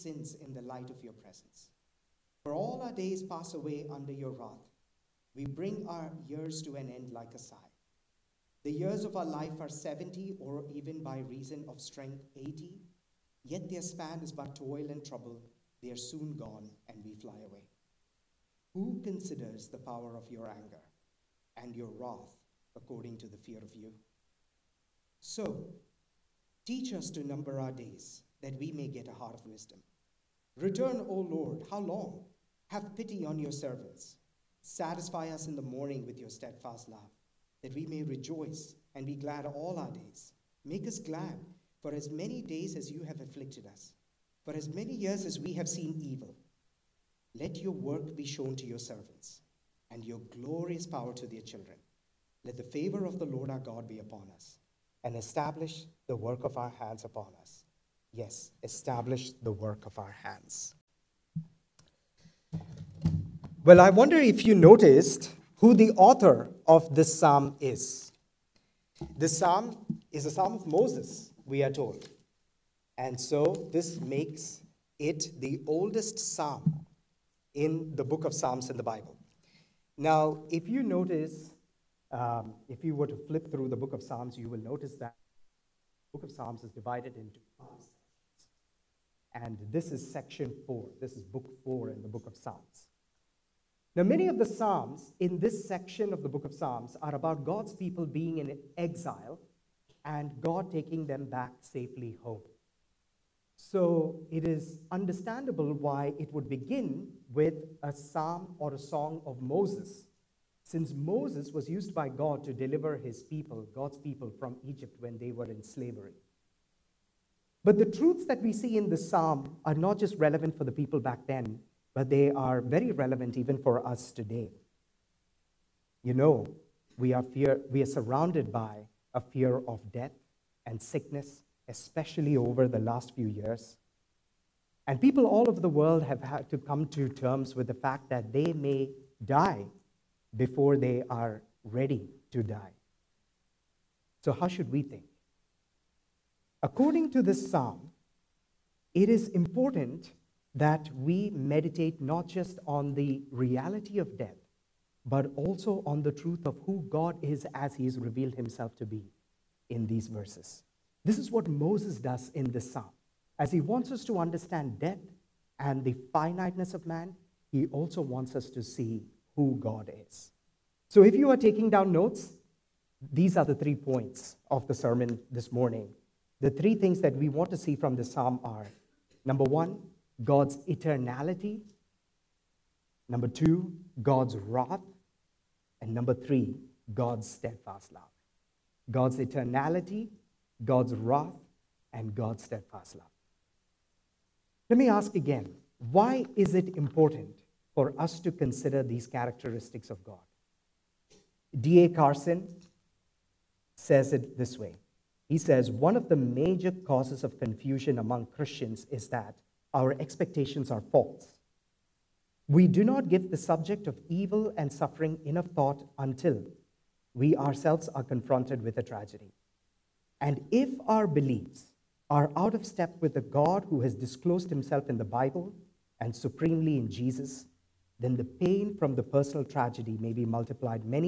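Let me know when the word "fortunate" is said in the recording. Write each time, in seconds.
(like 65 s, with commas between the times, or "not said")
not said.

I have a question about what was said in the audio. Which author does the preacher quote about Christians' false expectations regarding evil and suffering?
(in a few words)
D.A. Carson.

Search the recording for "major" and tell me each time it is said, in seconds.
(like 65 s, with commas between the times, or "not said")
206 s.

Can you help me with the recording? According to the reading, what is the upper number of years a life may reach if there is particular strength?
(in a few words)
80.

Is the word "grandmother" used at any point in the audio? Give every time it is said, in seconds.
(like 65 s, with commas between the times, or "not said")
not said.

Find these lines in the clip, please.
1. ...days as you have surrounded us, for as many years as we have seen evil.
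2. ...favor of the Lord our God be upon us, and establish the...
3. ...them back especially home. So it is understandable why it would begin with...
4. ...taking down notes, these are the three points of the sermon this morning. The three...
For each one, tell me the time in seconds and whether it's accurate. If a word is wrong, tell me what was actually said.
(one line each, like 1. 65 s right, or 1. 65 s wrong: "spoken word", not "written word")
1. 42 s wrong: "afflicted", not "surrounded"
2. 52 s right
3. 101 s wrong: "safely", not "especially"
4. 171 s right.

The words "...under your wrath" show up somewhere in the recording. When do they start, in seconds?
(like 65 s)
3 s.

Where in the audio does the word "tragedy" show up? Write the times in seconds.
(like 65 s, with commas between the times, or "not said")
218 s, 229 s.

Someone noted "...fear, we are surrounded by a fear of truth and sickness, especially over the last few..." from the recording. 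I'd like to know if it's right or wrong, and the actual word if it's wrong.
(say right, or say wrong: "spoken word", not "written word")
wrong: "death", not "truth".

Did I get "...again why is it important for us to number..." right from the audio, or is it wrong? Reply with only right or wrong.
wrong.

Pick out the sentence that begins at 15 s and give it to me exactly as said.
They are soon gone, and we fly away.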